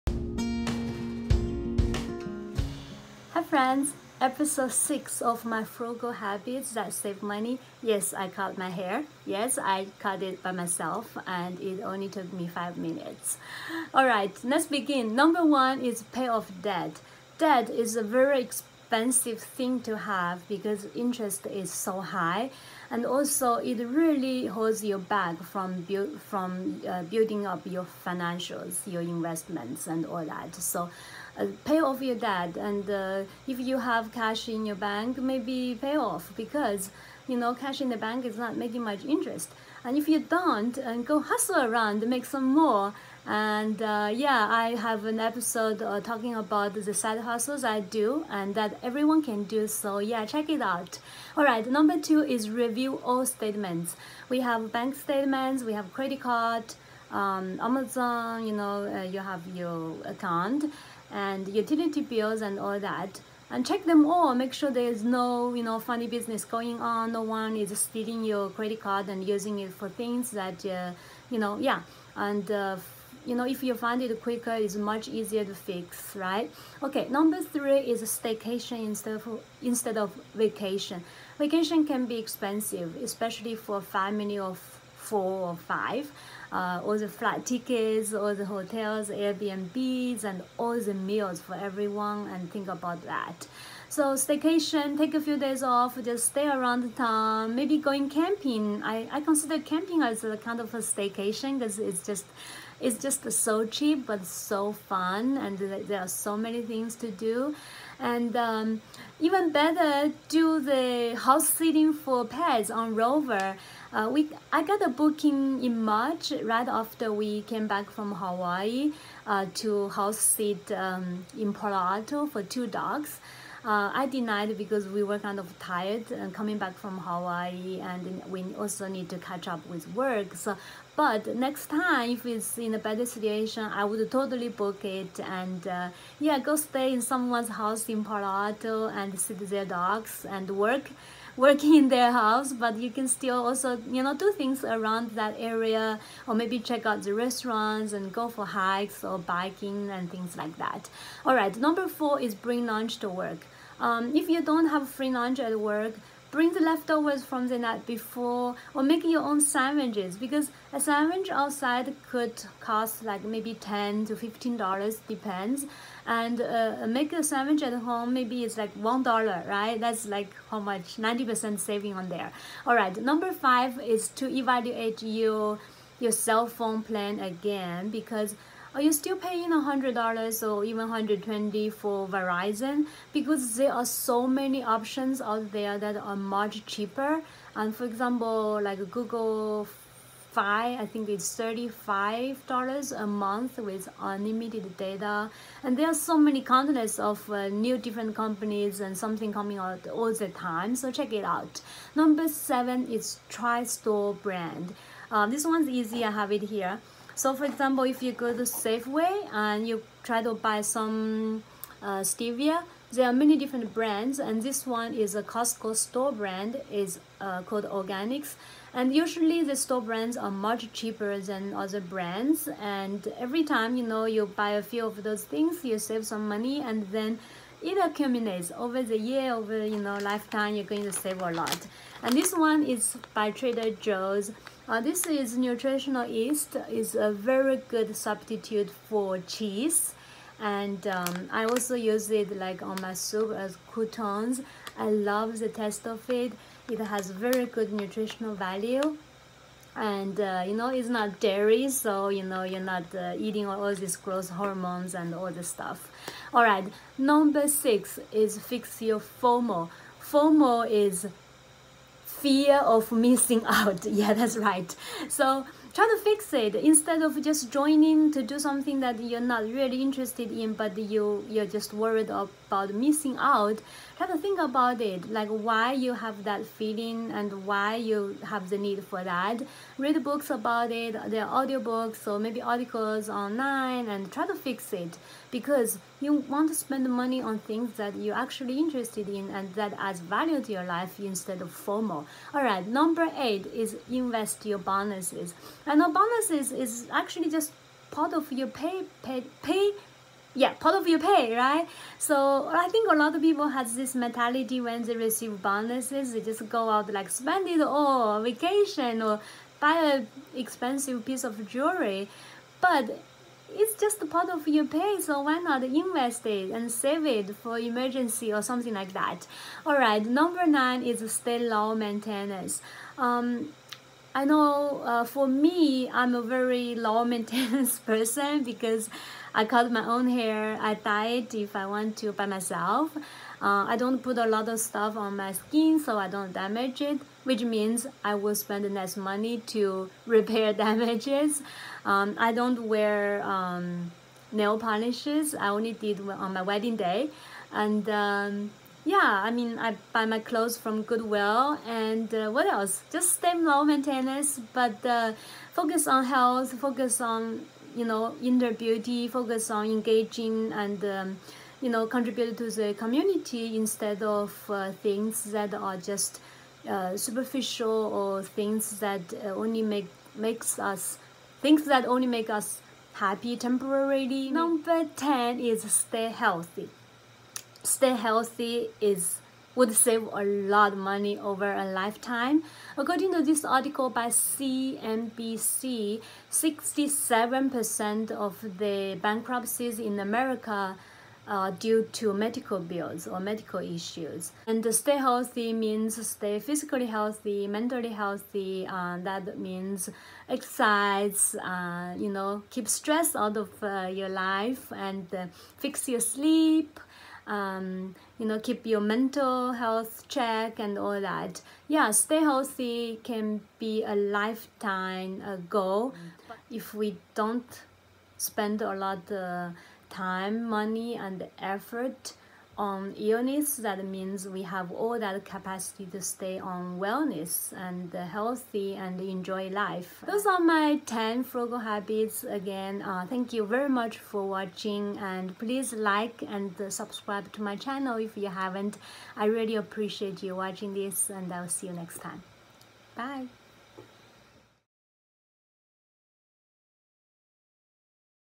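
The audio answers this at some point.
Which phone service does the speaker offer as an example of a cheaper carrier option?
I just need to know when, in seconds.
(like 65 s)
188 s.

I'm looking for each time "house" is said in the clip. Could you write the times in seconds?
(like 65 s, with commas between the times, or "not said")
111 s, 119 s, 137 s, 142 s.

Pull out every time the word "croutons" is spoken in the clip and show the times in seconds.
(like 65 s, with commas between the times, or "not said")
243 s.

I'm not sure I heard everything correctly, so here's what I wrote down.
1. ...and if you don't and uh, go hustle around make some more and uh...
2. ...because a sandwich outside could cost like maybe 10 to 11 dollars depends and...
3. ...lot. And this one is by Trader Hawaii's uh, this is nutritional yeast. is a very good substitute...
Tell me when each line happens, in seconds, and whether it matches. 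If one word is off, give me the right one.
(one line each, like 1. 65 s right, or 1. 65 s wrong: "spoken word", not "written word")
1. 39 s right
2. 160 s wrong: "15", not "11"
3. 231 s wrong: "Joe", not "Hawaii".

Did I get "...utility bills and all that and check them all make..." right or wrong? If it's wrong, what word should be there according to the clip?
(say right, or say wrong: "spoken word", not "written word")
right.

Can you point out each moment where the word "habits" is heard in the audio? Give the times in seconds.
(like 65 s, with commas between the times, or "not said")
6 s, 431 s.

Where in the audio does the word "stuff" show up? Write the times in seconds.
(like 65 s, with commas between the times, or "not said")
255 s, 334 s.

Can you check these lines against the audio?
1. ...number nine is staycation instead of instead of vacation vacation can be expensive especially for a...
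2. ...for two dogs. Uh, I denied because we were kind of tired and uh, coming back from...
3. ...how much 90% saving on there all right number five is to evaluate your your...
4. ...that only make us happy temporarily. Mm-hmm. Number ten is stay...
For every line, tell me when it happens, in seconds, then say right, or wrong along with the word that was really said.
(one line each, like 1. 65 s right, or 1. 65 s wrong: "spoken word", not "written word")
1. 77 s wrong: "three", not "nine"
2. 122 s right
3. 170 s right
4. 371 s right.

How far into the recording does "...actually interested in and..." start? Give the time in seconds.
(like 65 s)
288 s.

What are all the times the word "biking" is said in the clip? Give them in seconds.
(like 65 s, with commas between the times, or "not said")
149 s.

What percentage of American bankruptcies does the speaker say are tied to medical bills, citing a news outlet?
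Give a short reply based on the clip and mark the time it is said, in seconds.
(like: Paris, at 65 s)
67%, at 386 s.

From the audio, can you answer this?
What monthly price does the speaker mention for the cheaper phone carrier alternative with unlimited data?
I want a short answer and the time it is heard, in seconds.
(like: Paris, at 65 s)
$35, at 191 s.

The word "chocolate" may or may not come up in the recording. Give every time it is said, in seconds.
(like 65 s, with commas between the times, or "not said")
not said.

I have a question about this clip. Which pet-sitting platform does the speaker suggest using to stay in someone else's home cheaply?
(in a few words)
Rover.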